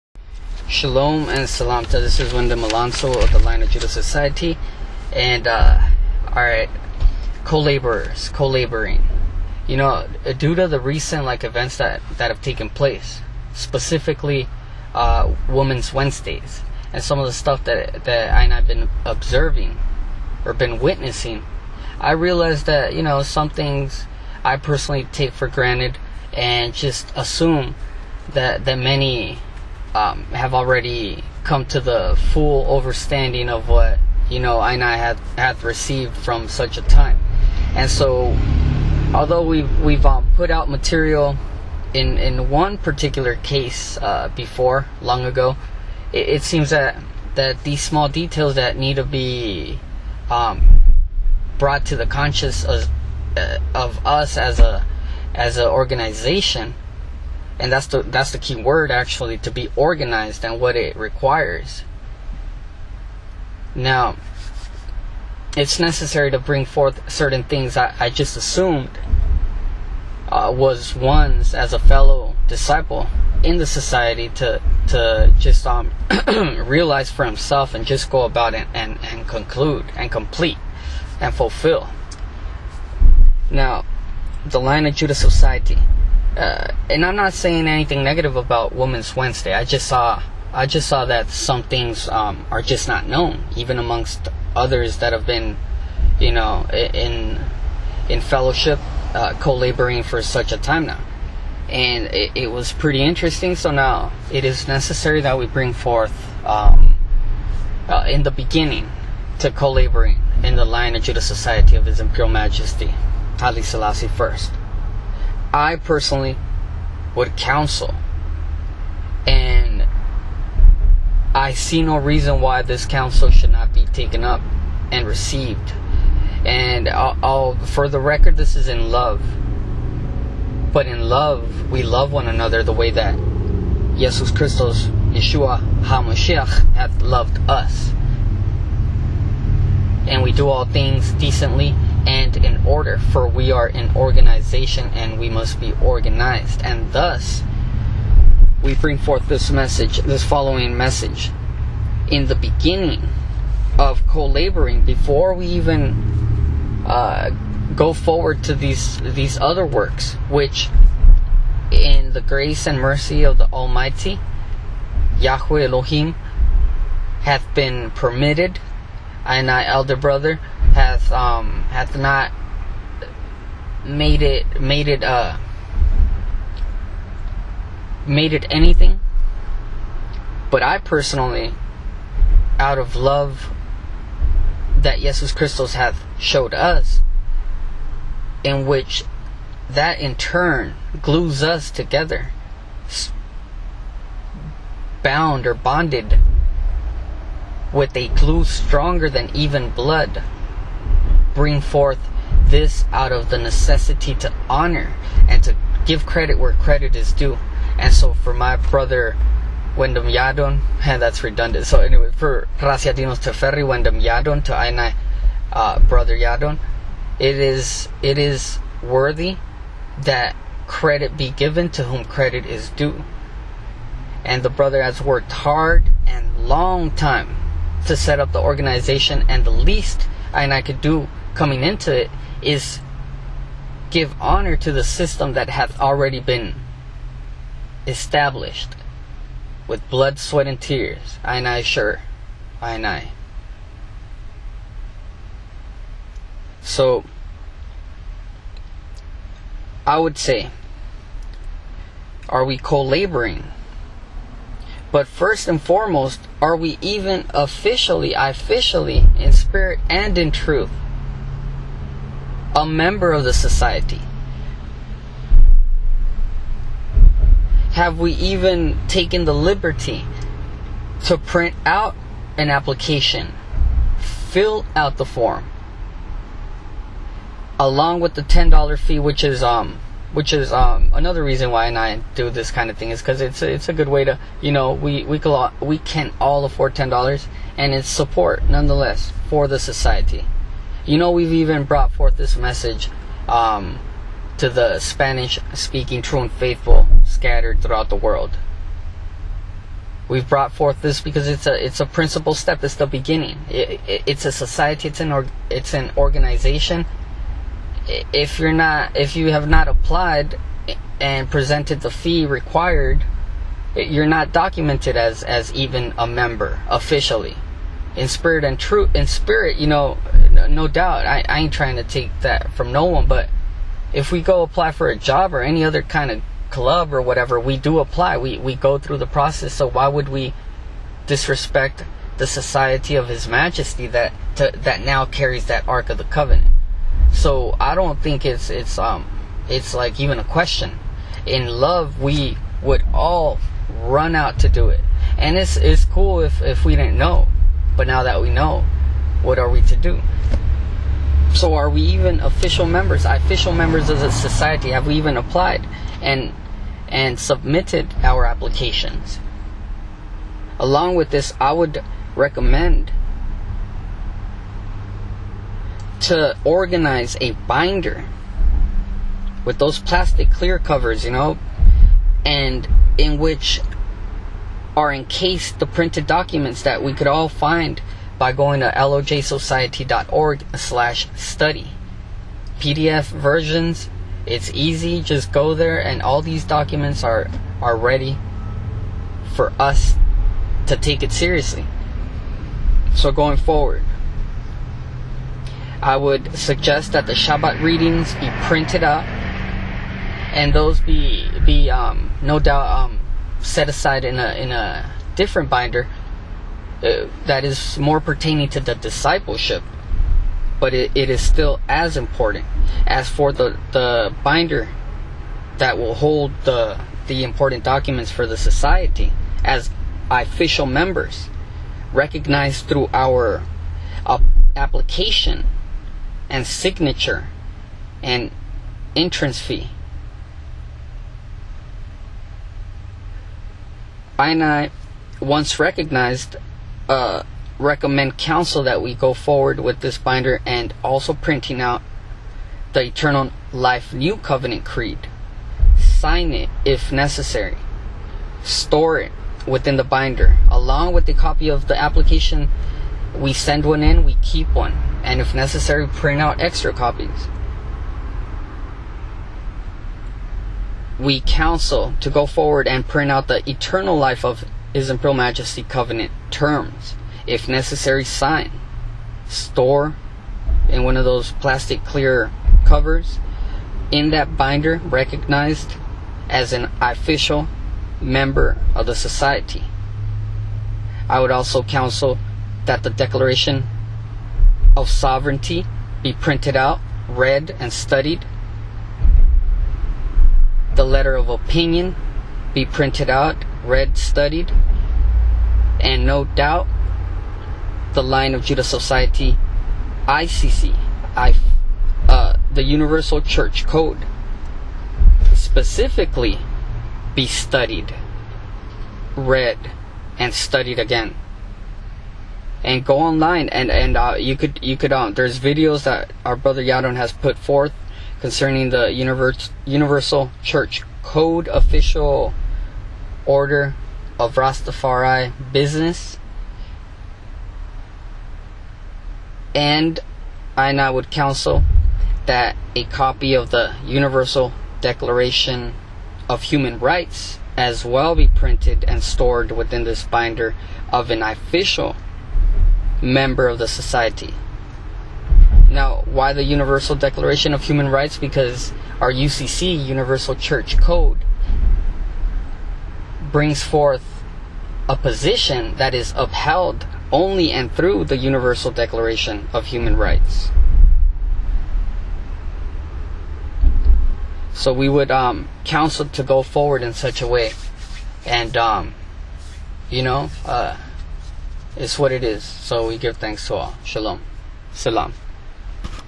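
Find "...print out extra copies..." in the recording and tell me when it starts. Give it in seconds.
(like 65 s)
455 s.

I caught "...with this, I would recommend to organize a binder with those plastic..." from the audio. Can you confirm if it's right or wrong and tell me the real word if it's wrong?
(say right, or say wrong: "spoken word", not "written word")
right.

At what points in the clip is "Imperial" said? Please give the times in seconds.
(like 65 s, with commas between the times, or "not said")
111 s, 464 s.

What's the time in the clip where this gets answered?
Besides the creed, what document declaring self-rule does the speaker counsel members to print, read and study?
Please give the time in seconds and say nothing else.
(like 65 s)
482 s.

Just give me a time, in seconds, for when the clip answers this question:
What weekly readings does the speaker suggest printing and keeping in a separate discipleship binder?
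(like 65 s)
397 s.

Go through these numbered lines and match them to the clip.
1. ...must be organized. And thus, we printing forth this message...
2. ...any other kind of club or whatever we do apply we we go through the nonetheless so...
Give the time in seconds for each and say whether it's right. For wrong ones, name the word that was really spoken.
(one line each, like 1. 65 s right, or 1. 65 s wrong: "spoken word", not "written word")
1. 145 s wrong: "bring", not "printing"
2. 325 s wrong: "process", not "nonetheless".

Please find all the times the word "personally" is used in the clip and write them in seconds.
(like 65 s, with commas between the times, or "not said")
24 s, 115 s, 180 s.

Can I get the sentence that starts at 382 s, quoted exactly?
PDF versions, it's easy, just go there and all these documents are, are ready for us to take it seriously.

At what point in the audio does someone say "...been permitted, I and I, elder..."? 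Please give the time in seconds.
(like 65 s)
167 s.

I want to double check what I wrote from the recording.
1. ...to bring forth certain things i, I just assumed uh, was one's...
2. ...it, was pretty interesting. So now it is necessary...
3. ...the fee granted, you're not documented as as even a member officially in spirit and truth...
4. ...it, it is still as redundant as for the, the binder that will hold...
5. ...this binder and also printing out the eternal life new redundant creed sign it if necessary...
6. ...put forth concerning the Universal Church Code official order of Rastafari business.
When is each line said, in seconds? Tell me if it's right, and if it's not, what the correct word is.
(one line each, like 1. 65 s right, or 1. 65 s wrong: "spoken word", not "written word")
1. 66 s right
2. 102 s right
3. 311 s wrong: "required", not "granted"
4. 410 s wrong: "important", not "redundant"
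5. 439 s wrong: "covenant", not "redundant"
6. 517 s right.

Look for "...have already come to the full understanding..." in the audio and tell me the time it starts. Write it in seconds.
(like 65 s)
30 s.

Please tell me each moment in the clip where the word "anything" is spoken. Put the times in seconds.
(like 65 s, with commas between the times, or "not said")
87 s, 178 s.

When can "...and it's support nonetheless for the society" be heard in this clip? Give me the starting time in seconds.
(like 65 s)
287 s.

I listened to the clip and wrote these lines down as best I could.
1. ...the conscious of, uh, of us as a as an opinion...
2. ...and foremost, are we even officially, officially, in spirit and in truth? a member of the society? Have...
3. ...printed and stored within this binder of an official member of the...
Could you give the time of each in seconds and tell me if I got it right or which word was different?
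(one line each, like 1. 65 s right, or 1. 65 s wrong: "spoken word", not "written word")
1. 51 s wrong: "organization", not "opinion"
2. 255 s right
3. 538 s right.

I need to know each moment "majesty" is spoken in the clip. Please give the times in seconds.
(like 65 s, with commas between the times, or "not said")
112 s, 333 s, 465 s.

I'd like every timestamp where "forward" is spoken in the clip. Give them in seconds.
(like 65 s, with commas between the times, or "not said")
157 s, 393 s, 439 s, 462 s, 566 s.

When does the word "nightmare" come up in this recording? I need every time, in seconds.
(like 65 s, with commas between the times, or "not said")
not said.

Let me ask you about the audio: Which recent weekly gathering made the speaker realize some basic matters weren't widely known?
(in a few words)
Women's Wednesdays.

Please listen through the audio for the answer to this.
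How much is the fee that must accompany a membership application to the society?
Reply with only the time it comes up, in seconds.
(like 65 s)
278 s.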